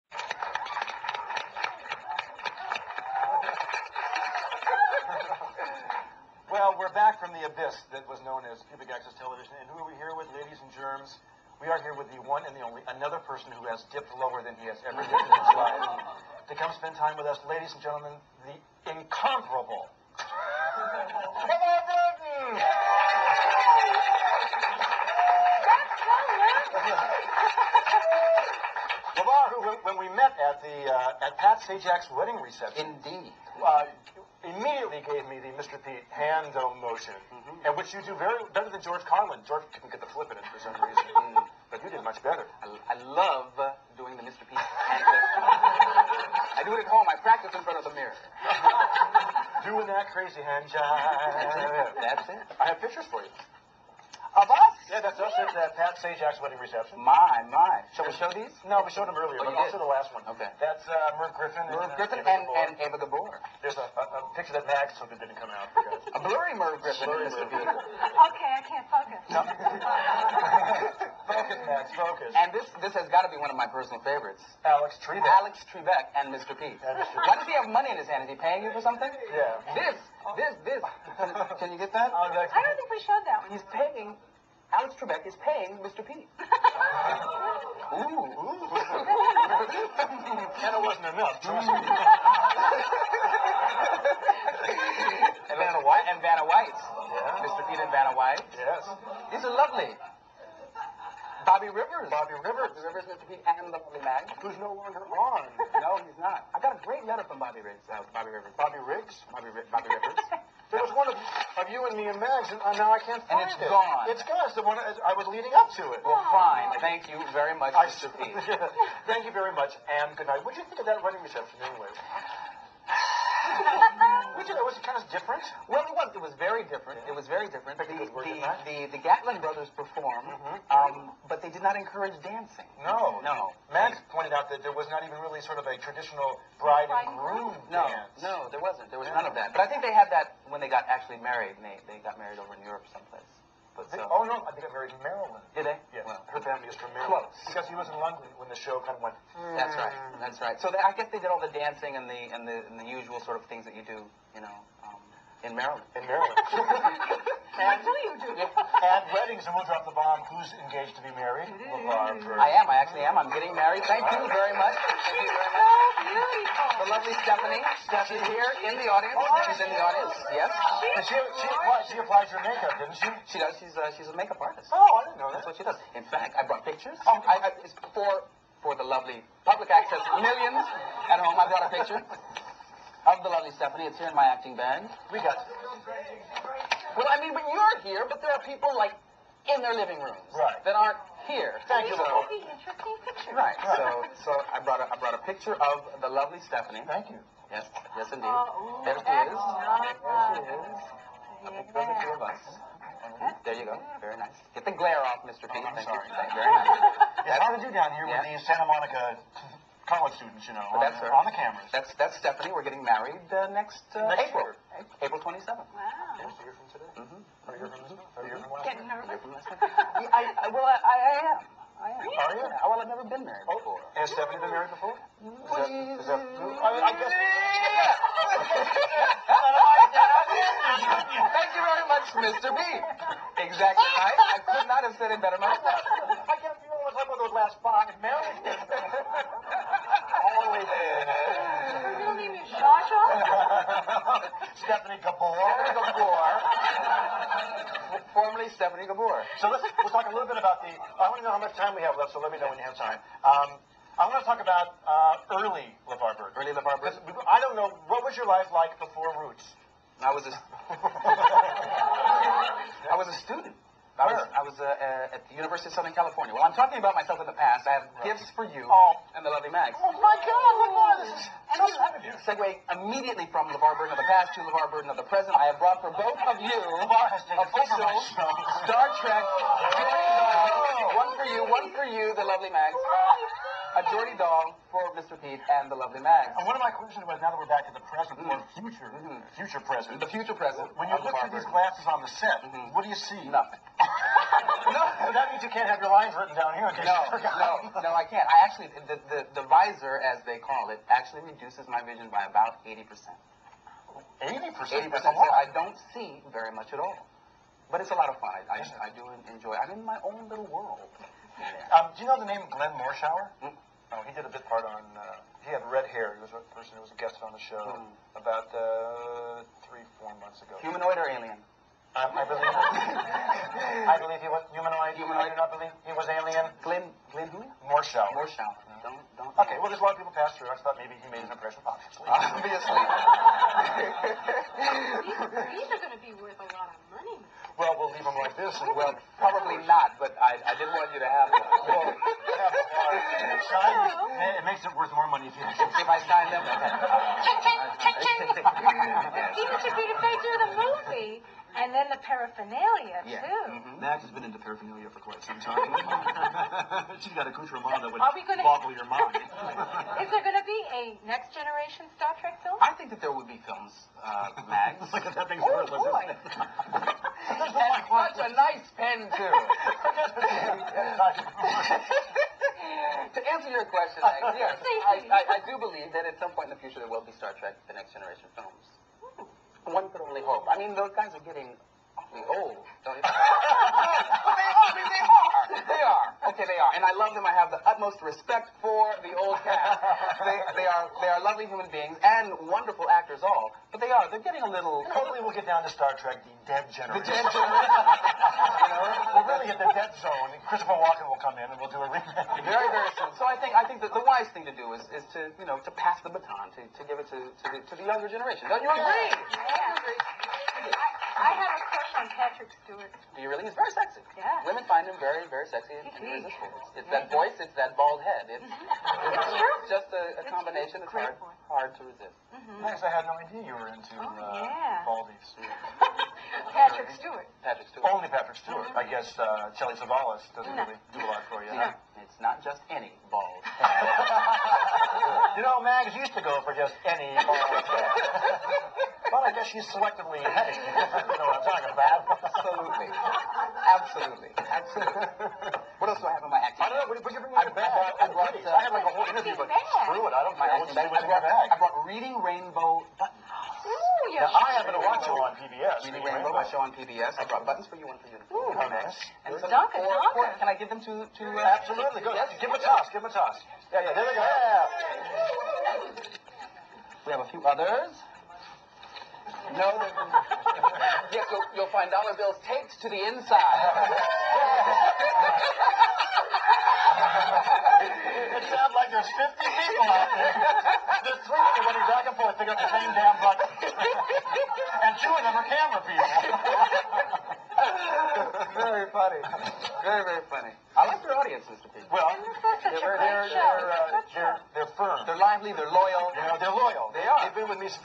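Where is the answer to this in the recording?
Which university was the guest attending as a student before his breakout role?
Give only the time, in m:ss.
4:25.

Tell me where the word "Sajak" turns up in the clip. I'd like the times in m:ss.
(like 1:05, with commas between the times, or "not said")
0:31, 0:56.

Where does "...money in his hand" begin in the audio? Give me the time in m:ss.
1:17.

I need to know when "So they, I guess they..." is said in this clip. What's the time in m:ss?
2:30.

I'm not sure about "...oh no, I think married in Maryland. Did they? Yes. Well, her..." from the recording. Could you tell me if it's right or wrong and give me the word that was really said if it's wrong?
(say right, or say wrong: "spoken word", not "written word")
right.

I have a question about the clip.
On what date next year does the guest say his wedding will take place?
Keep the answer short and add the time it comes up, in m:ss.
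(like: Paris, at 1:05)
April 27th, at 3:35.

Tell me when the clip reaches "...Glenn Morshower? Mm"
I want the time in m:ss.
5:12.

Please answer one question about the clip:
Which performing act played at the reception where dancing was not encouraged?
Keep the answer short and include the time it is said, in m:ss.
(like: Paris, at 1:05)
Gatlin brothers, at 2:08.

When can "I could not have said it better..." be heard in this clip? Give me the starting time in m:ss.
3:54.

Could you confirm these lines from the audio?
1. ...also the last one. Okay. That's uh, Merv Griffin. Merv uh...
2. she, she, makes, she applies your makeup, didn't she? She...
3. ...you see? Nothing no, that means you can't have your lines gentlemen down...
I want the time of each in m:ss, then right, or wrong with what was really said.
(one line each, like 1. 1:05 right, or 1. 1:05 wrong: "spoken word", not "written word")
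1. 0:59 right
2. 2:51 wrong: "applies", not "makes"
3. 4:52 wrong: "written", not "gentlemen".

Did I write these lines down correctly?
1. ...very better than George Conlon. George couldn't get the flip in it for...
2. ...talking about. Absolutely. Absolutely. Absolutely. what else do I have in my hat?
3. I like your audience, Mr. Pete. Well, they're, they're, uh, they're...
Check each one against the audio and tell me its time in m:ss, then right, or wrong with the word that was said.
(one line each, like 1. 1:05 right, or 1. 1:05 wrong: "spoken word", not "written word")
1. 0:38 right
2. 7:21 right
3. 8:10 right.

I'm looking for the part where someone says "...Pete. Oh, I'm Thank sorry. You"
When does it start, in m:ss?
3:25.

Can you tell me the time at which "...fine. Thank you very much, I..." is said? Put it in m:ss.
1:56.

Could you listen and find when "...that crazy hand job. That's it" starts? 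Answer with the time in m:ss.
0:49.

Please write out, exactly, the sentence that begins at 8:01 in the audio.
There's three that running back and forth, they got the same damn button.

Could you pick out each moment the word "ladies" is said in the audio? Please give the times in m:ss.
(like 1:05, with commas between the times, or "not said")
0:10, 0:17.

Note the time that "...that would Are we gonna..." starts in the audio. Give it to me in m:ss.
5:57.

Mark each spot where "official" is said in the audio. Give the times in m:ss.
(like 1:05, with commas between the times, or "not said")
4:37.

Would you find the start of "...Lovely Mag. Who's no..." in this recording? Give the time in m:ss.
1:43.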